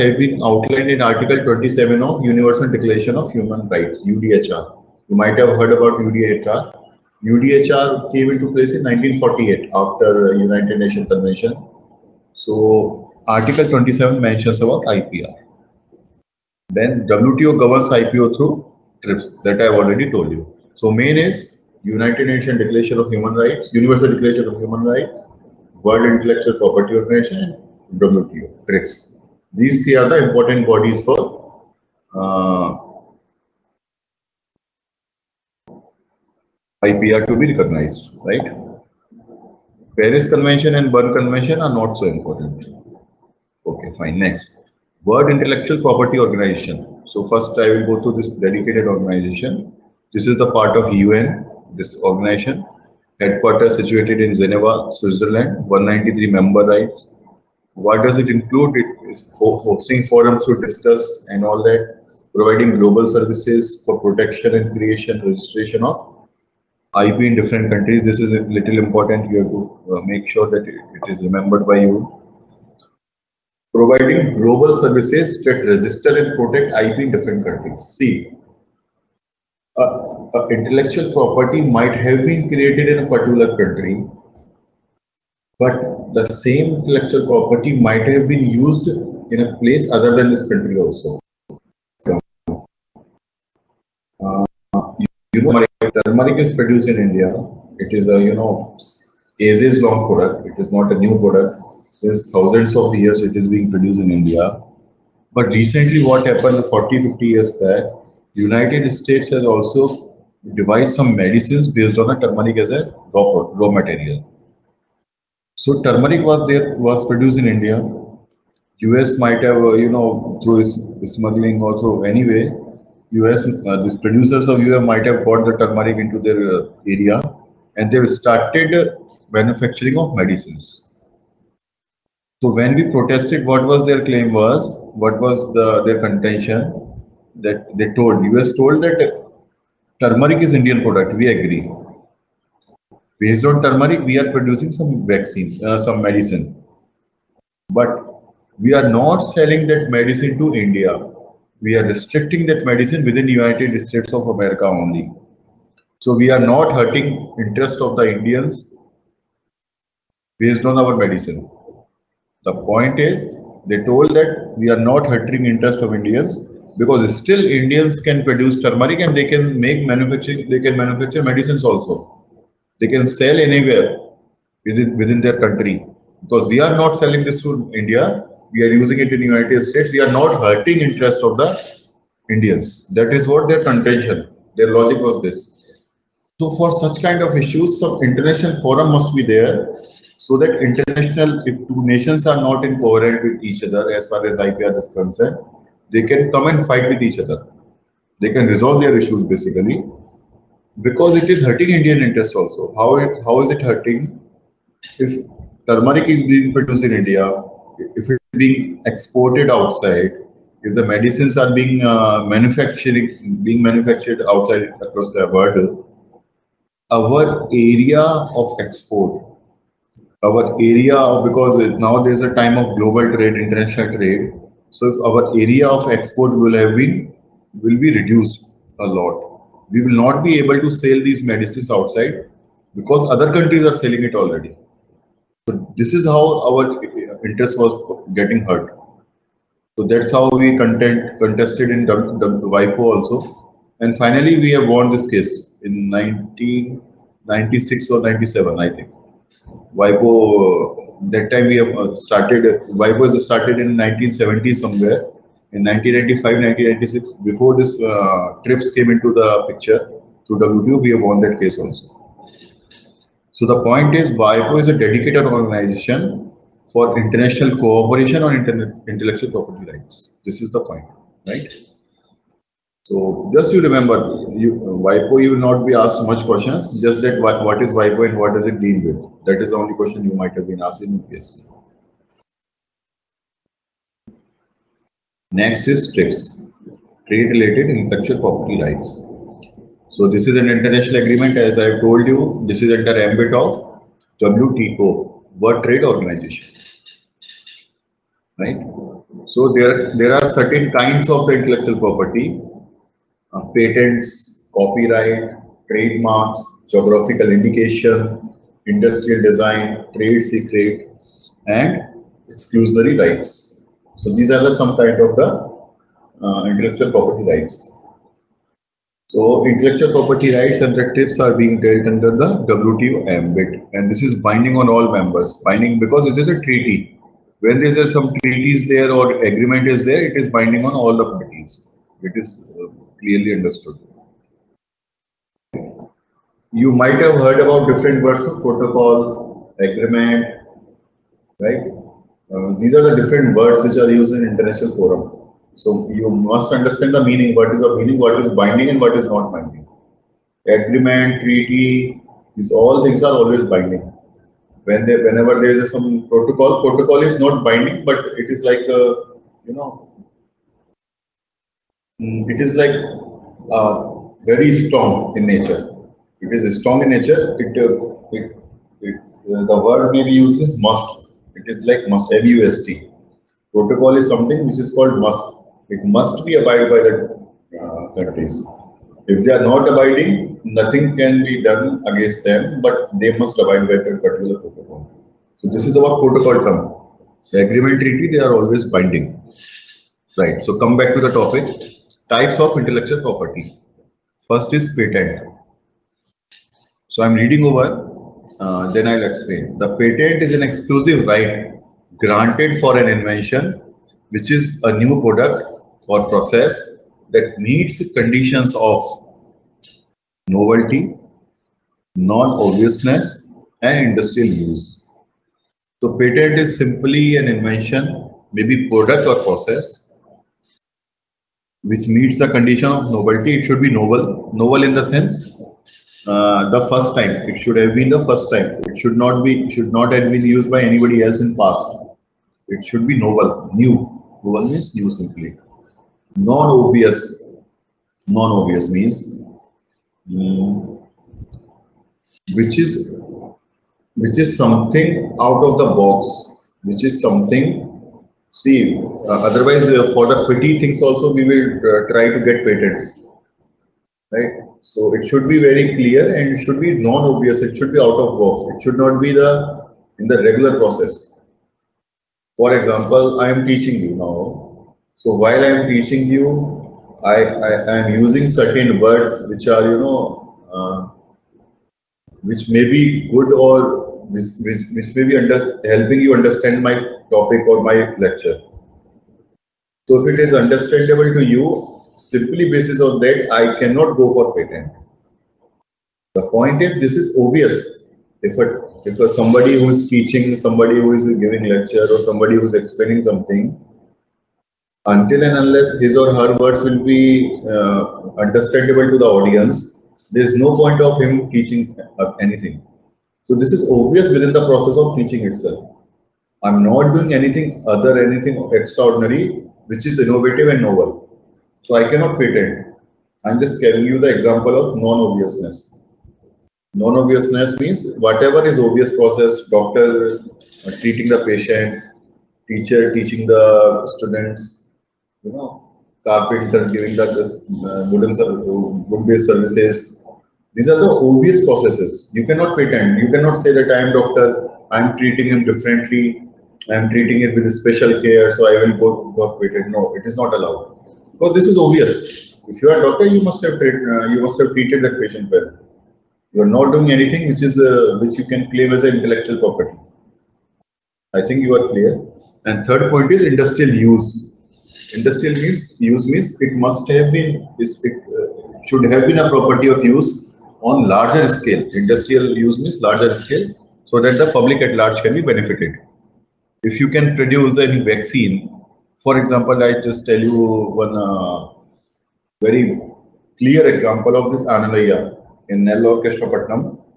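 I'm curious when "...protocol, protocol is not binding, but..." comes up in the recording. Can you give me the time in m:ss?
5:56.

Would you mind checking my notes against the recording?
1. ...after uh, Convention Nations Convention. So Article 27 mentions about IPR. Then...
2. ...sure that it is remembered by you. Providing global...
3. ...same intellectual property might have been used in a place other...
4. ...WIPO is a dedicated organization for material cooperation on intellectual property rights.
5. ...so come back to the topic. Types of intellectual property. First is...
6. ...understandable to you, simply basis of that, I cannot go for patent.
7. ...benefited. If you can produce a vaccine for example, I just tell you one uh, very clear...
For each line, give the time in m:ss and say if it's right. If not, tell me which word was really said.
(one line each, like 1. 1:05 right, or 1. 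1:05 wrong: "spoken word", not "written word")
1. 0:09 wrong: "United", not "Convention"
2. 1:10 right
3. 1:26 right
4. 4:24 wrong: "international", not "material"
5. 6:30 right
6. 8:00 right
7. 9:25 right.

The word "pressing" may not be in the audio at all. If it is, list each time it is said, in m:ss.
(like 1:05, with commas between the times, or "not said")
not said.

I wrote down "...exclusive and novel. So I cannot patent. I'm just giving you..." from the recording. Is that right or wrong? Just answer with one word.
wrong.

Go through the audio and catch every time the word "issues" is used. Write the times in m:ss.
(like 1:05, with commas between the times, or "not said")
3:07, 3:18.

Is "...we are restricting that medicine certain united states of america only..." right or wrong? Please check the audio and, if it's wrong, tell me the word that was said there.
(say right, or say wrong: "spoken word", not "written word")
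wrong: "within", not "certain".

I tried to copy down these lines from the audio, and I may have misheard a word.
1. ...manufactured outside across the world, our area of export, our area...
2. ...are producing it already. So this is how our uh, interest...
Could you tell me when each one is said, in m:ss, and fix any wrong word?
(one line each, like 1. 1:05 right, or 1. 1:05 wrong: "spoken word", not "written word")
1. 3:33 right
2. 3:53 wrong: "selling", not "producing".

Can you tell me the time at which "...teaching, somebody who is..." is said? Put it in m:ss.
8:09.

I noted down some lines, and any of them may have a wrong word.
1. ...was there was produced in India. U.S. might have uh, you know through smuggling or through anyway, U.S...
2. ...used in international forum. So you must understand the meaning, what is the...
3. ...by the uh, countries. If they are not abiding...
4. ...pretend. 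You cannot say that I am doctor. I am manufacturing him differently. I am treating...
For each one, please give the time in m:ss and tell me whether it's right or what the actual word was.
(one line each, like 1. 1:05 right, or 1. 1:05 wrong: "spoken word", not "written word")
1. 1:56 right
2. 5:43 right
3. 6:16 right
4. 8:52 wrong: "treating", not "manufacturing".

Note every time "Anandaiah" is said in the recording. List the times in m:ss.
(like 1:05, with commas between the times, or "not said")
9:34.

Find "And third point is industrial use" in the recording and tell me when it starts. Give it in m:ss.
9:12.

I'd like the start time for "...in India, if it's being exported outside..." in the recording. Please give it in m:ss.
3:26.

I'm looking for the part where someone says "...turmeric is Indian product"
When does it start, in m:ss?
2:19.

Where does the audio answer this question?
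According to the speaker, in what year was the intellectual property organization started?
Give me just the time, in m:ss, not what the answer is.
4:13.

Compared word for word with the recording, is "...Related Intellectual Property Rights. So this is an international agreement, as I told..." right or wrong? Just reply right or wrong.
right.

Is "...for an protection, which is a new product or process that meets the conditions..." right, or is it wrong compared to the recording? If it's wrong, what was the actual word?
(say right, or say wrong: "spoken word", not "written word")
wrong: "invention", not "protection".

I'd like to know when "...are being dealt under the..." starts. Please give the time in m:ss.
5:21.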